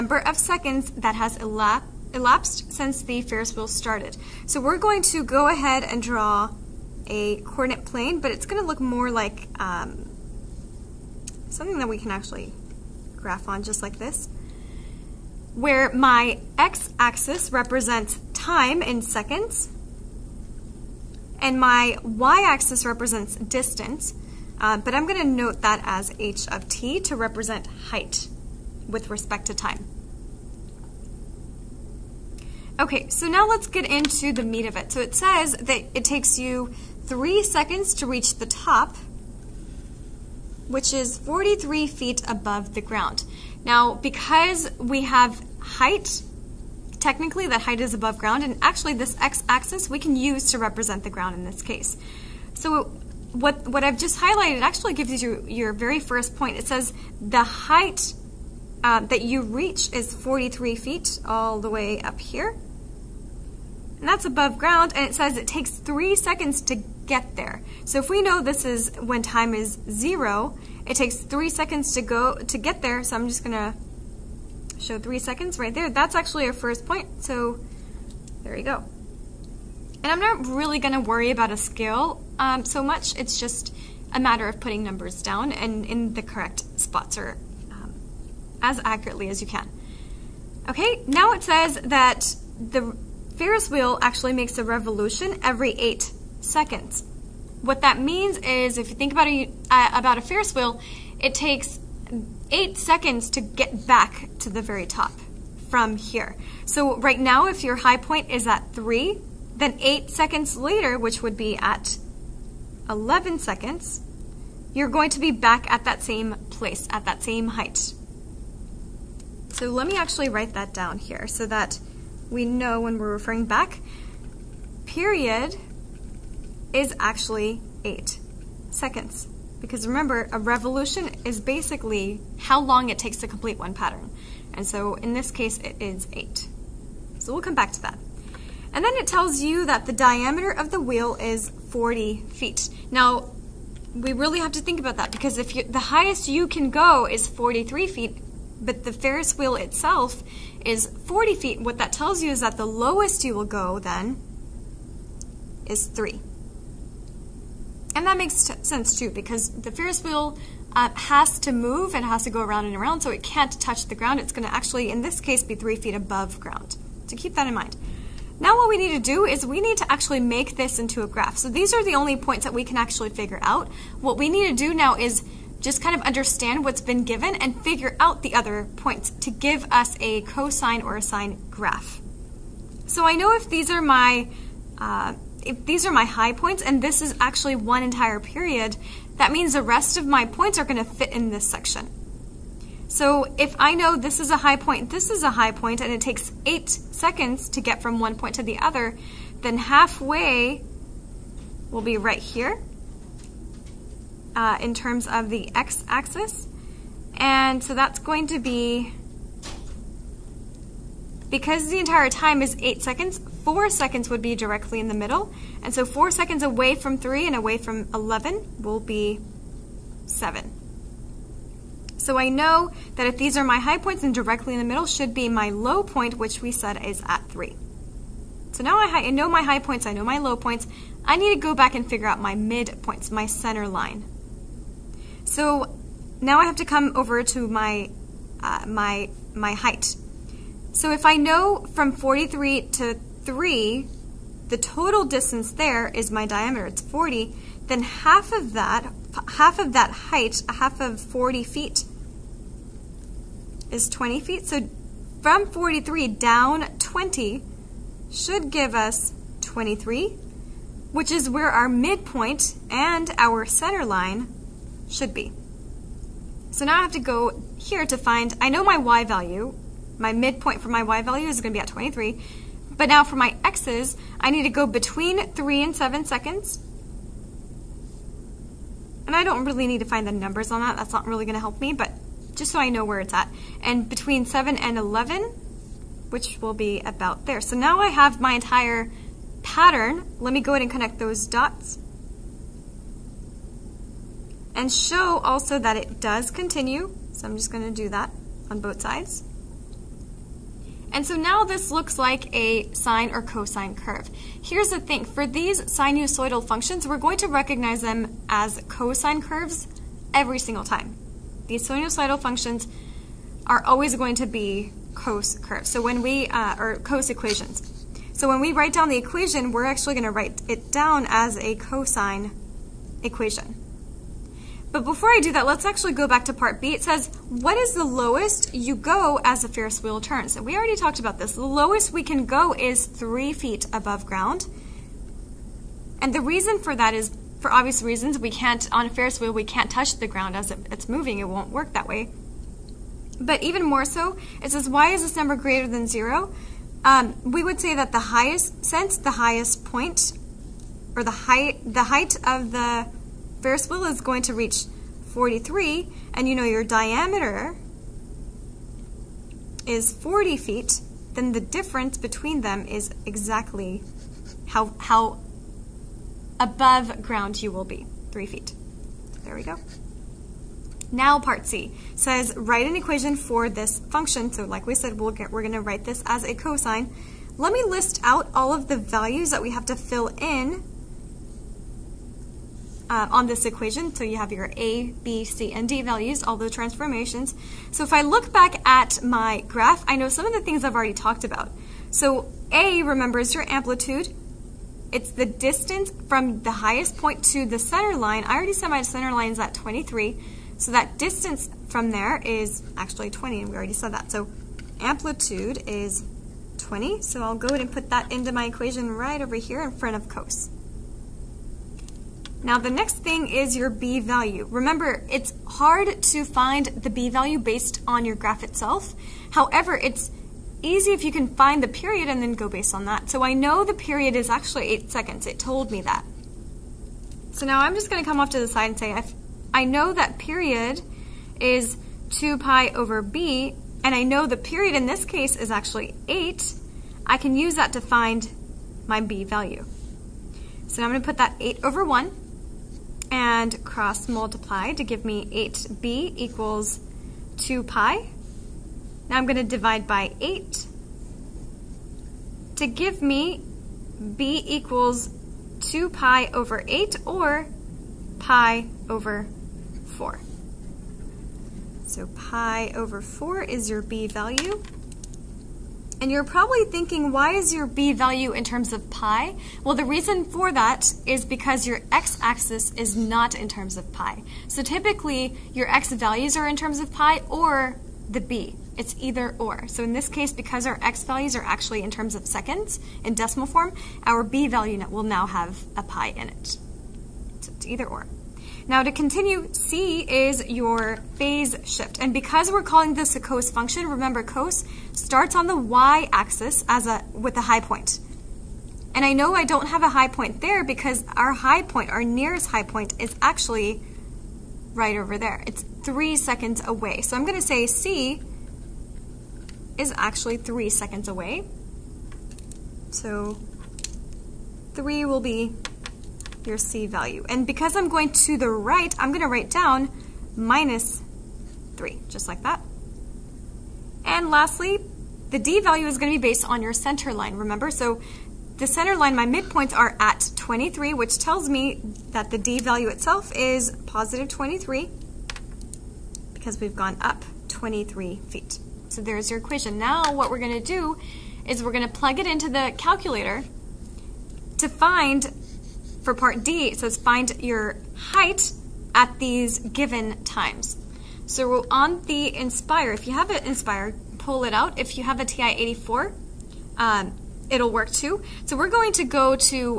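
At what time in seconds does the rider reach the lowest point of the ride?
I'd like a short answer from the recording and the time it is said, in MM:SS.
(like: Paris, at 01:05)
7, at 03:40.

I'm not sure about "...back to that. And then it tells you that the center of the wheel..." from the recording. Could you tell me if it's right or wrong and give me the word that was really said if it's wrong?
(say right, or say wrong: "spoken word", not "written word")
wrong: "diameter", not "center".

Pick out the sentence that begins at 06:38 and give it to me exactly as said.
I already said my center line is at 23.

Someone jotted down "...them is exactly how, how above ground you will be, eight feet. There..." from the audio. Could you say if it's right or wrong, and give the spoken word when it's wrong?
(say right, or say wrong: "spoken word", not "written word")
wrong: "three", not "eight".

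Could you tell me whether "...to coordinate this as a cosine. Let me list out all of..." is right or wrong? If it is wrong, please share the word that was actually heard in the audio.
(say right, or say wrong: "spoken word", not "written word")
wrong: "write", not "coordinate".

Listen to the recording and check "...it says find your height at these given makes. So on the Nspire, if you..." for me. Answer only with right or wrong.
wrong.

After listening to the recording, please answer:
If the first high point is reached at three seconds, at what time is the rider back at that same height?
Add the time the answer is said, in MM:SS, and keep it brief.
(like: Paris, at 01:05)
11 seconds, at 01:52.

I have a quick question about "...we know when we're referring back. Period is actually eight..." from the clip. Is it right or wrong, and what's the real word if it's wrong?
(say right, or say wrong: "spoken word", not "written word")
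right.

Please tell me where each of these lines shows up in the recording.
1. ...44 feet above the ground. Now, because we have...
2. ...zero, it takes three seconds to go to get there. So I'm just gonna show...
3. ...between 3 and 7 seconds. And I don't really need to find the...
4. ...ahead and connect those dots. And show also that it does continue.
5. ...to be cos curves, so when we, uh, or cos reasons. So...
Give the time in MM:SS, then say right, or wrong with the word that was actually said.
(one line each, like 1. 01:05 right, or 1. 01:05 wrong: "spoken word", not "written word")
1. 00:41 wrong: "43", not "44"
2. 01:09 right
3. 04:34 right
4. 04:50 right
5. 05:14 wrong: "equations", not "reasons".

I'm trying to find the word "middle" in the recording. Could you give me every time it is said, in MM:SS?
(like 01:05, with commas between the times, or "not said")
03:34, 03:44.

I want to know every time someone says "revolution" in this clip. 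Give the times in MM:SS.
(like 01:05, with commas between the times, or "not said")
01:34, 02:10.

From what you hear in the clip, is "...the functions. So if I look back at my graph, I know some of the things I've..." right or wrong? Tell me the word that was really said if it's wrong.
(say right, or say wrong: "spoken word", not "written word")
wrong: "transformations", not "functions".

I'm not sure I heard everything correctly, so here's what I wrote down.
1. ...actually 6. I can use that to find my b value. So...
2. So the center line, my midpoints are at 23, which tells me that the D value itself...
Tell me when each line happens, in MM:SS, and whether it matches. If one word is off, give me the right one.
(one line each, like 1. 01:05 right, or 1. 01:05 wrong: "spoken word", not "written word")
1. 07:15 wrong: "8", not "6"
2. 08:47 right.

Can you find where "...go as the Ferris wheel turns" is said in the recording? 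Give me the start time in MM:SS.
05:28.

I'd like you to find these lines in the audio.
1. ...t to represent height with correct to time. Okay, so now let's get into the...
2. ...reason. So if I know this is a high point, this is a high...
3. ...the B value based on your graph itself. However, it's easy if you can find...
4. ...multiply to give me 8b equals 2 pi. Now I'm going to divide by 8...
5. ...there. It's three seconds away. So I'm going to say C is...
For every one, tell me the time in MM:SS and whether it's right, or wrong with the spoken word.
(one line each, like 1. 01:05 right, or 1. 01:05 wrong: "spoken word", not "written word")
1. 00:26 wrong: "respect", not "correct"
2. 03:11 wrong: "section", not "reason"
3. 06:56 right
4. 07:24 right
5. 08:25 right.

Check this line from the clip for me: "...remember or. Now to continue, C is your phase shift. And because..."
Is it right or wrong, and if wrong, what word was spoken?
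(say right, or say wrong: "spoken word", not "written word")
wrong: "either", not "remember".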